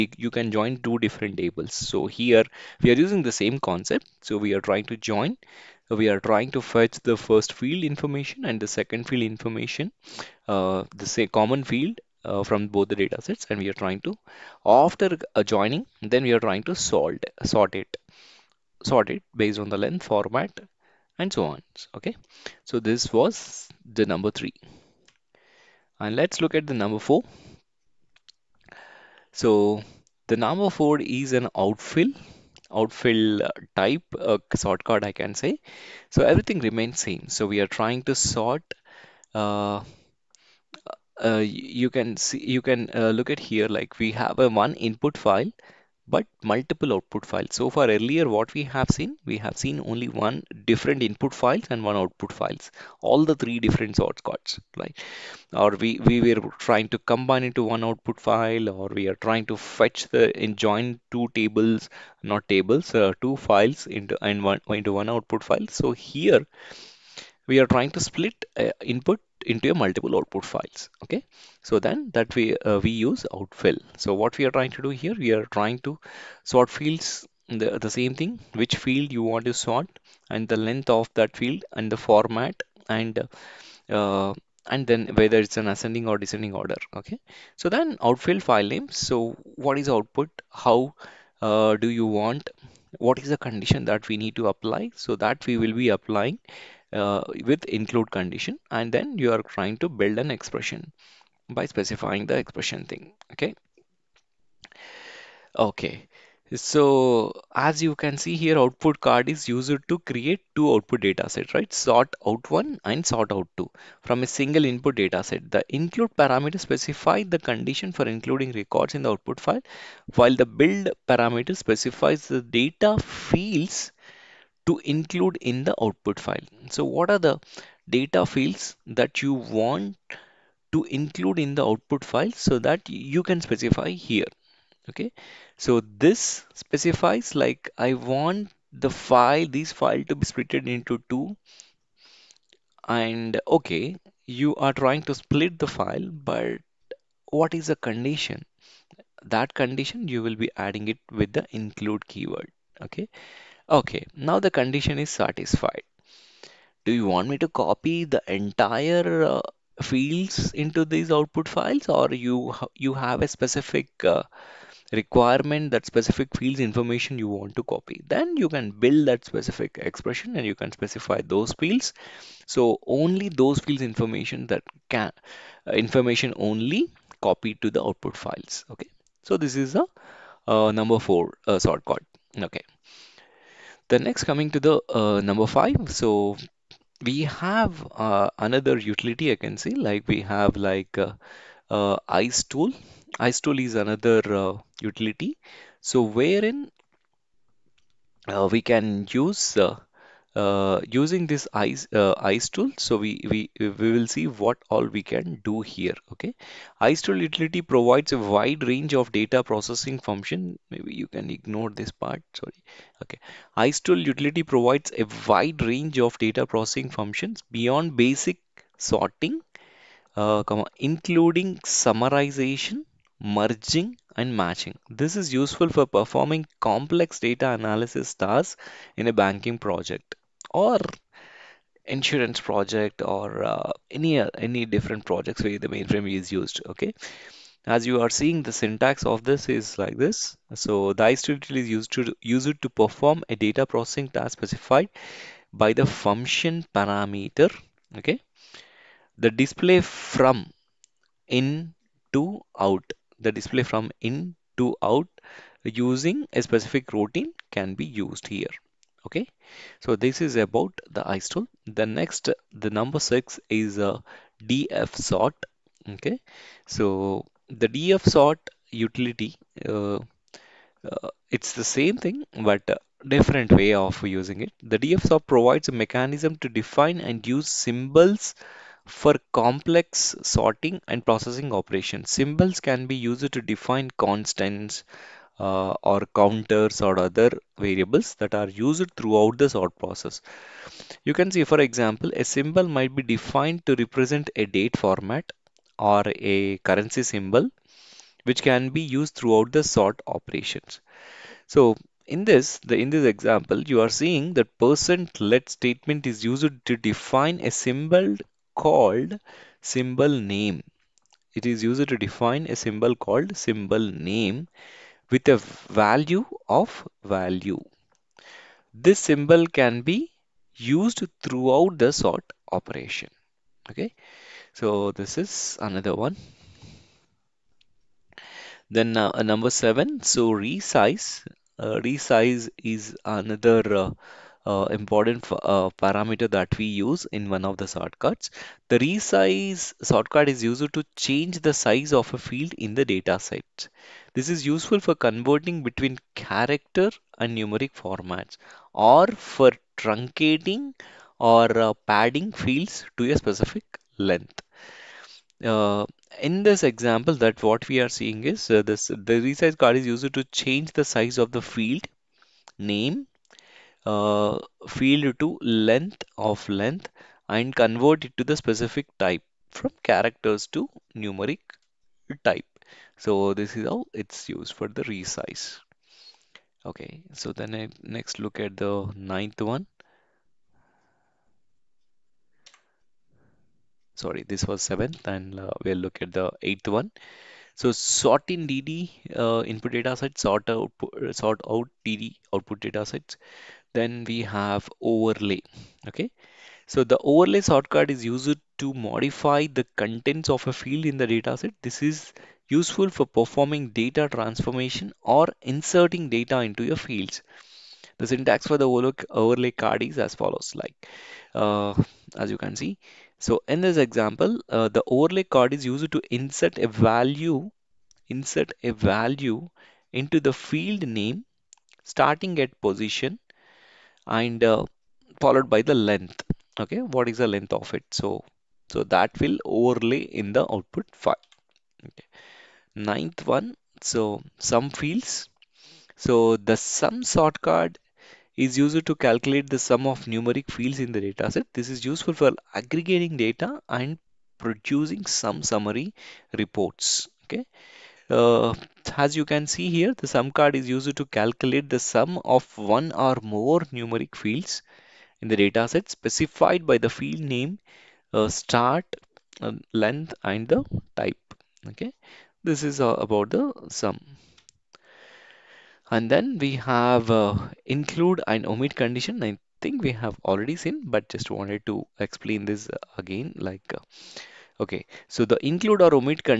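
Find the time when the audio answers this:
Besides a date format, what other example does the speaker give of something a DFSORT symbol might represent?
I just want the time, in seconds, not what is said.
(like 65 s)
296 s.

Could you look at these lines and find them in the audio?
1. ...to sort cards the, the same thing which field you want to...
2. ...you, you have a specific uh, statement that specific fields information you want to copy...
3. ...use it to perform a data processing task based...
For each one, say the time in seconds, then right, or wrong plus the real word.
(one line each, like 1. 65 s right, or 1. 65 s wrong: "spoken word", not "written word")
1. 75 s wrong: "fields", not "cards"
2. 162 s wrong: "requirement", not "statement"
3. 242 s wrong: "specified", not "based".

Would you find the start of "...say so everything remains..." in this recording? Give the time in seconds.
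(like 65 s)
35 s.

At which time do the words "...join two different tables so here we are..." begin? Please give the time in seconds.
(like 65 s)
0 s.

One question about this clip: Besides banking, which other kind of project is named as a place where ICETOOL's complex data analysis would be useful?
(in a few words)
Insurance project.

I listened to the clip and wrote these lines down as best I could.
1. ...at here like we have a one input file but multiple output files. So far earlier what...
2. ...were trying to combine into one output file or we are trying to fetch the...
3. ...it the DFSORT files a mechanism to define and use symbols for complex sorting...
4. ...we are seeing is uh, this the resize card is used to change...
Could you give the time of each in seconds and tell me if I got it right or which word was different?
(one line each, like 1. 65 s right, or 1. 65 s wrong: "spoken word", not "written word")
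1. 43 s right
2. 56 s right
3. 274 s wrong: "provides", not "files"
4. 357 s right.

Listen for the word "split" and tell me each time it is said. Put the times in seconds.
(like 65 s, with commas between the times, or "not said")
68 s, 140 s, 145 s.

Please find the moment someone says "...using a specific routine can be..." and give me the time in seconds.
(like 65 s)
255 s.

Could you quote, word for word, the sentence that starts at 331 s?
Uh, resize is another uh, uh, important uh, parameter that we use in one of the sort cards.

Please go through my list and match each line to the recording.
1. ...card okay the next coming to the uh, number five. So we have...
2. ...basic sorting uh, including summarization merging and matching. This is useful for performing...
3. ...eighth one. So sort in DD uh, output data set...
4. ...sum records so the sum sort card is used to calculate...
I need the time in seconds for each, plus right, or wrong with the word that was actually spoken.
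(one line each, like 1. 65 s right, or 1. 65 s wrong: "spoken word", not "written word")
1. 181 s right
2. 217 s right
3. 386 s wrong: "input", not "output"
4. 434 s wrong: "fields", not "records".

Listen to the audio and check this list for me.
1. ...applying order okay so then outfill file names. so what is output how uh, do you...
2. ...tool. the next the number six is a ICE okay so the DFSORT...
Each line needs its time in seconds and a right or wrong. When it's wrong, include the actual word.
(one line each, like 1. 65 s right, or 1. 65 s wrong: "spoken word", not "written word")
1. 86 s wrong: "descending", not "applying"
2. 261 s wrong: "DFSORT", not "ICE".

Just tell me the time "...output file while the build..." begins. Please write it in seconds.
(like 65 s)
119 s.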